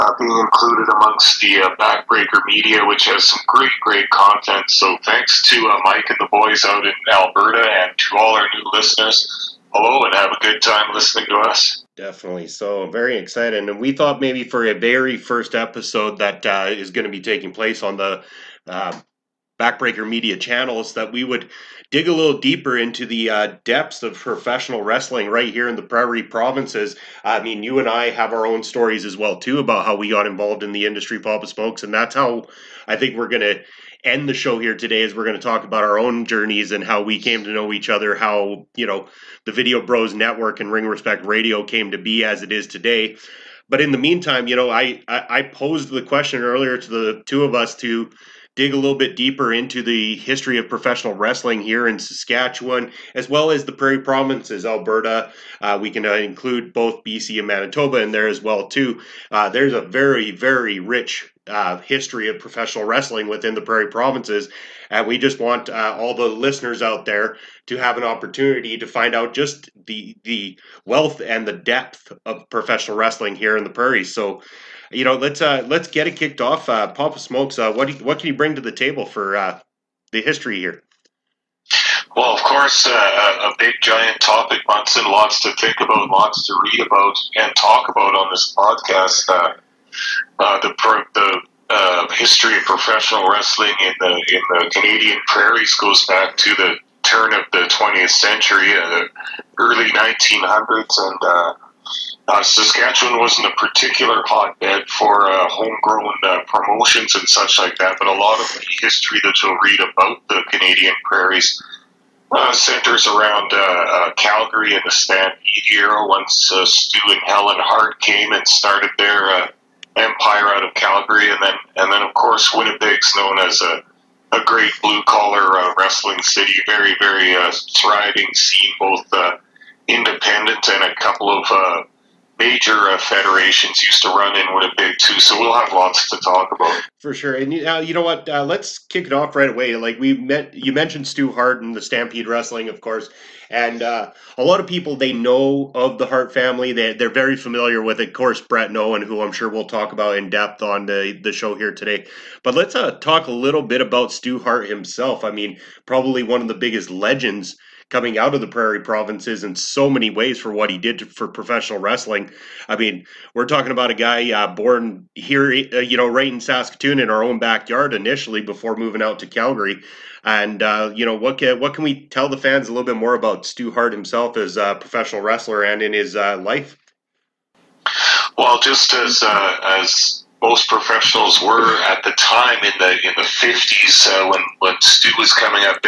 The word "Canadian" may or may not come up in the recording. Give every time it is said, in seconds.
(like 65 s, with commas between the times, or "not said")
94 s, 110 s.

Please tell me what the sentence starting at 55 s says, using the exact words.
Uh, we can uh, include both BC and Manitoba in there as well too.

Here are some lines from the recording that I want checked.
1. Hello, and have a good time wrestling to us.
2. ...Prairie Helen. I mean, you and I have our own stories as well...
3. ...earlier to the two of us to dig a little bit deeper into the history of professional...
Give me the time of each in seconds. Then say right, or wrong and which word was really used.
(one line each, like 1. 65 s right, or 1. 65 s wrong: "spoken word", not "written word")
1. 9 s wrong: "listening", not "wrestling"
2. 25 s wrong: "Provinces", not "Helen"
3. 46 s right.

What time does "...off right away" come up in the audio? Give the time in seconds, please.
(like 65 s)
139 s.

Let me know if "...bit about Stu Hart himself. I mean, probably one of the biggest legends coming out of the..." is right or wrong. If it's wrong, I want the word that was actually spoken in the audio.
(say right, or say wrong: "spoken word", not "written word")
right.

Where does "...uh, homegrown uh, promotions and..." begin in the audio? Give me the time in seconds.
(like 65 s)
105 s.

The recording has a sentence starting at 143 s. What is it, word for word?
And uh, a lot of people they know of the Hart family.